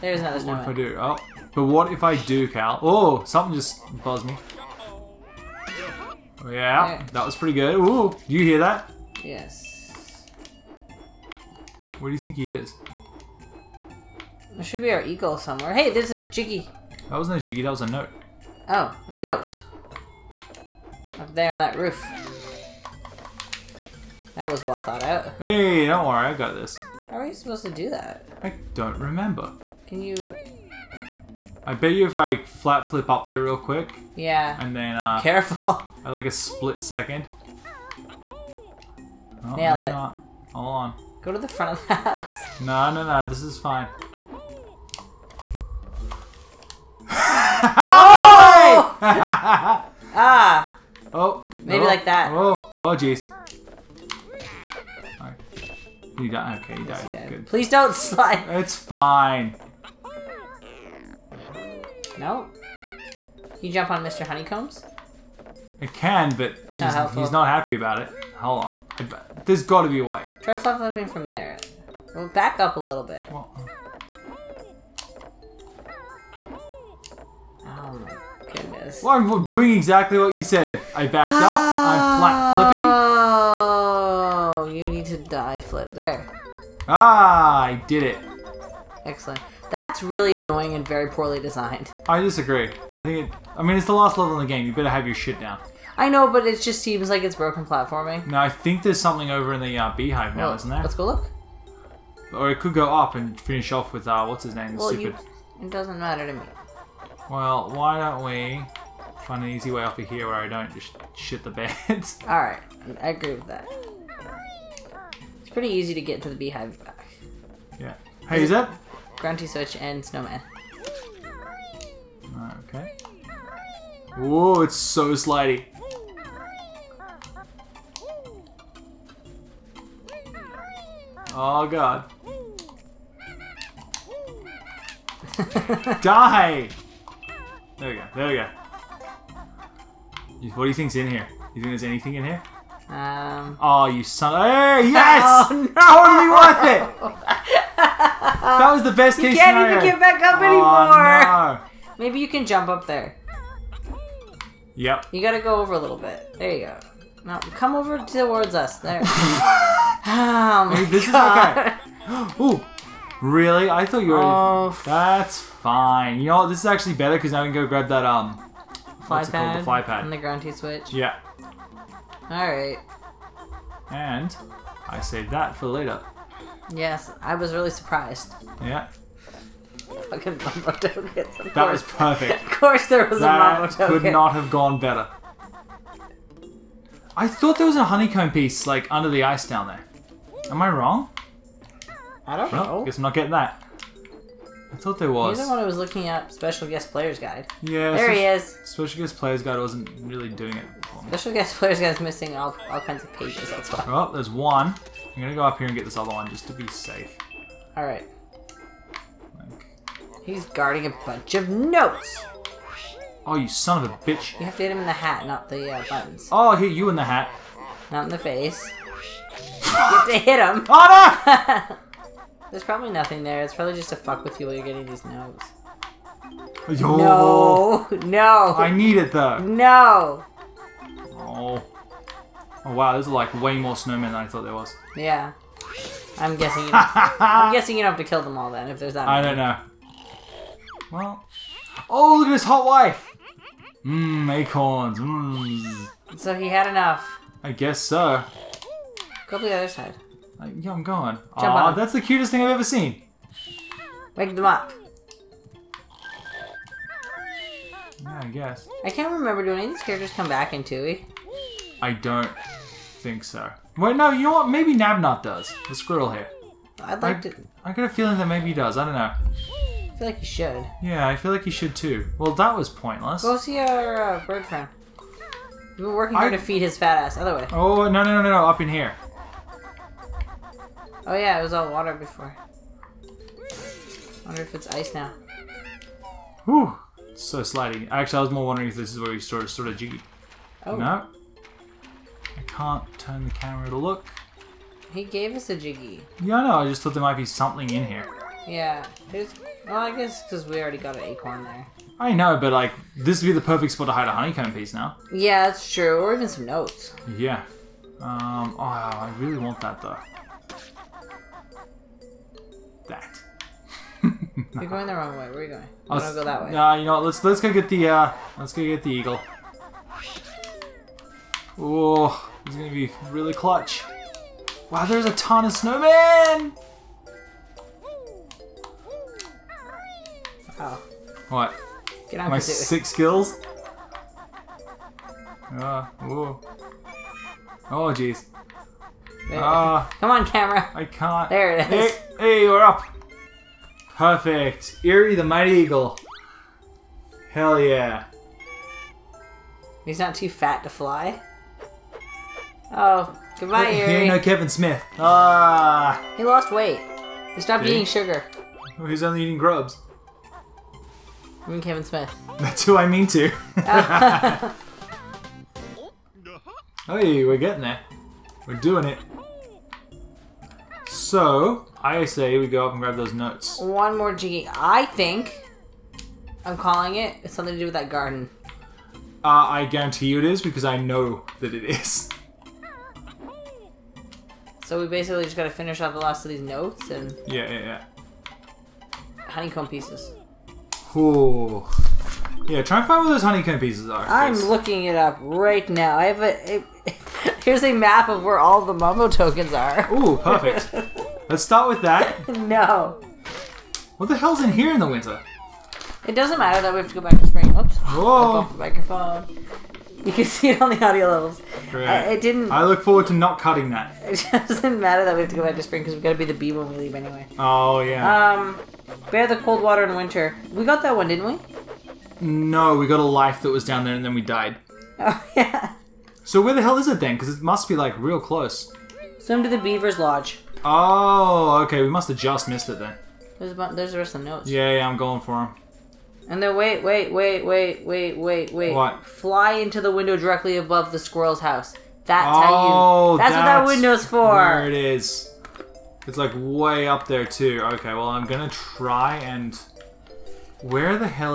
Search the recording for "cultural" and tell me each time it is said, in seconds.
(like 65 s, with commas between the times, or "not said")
not said.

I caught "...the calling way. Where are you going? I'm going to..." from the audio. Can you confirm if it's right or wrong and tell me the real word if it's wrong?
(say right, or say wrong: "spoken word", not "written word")
wrong: "wrong", not "calling".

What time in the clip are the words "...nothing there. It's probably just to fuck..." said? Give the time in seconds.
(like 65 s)
222 s.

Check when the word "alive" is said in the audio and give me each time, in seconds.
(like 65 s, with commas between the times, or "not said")
not said.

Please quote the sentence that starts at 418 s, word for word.
Um, bear the cold water in winter.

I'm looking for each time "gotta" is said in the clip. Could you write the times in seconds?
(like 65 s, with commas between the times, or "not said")
155 s, 385 s.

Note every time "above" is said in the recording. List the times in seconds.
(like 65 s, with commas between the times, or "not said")
440 s.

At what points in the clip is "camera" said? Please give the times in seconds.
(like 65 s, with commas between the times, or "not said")
293 s, 340 s.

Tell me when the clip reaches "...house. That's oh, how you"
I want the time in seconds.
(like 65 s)
441 s.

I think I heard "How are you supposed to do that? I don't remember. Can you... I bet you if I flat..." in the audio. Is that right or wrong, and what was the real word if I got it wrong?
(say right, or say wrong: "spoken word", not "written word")
right.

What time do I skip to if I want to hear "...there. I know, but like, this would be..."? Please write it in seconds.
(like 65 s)
301 s.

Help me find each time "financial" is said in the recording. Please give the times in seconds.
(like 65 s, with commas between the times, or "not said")
not said.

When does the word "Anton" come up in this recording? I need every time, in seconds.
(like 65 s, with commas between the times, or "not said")
not said.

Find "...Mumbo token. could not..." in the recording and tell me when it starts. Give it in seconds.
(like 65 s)
183 s.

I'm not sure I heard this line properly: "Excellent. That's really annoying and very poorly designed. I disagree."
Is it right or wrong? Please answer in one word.
right.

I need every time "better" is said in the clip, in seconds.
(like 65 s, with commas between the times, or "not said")
94 s, 166 s, 184 s.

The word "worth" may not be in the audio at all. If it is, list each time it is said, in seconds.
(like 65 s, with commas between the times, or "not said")
146 s.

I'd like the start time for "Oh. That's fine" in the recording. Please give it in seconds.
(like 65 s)
164 s.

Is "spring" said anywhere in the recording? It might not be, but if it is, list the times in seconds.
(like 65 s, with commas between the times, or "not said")
407 s, 415 s.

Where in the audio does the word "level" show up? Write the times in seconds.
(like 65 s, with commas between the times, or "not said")
94 s, 411 s.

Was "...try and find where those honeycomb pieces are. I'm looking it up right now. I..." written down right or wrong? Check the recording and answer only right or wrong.
right.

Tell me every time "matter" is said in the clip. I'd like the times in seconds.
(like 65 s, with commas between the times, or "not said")
105 s, 406 s, 414 s.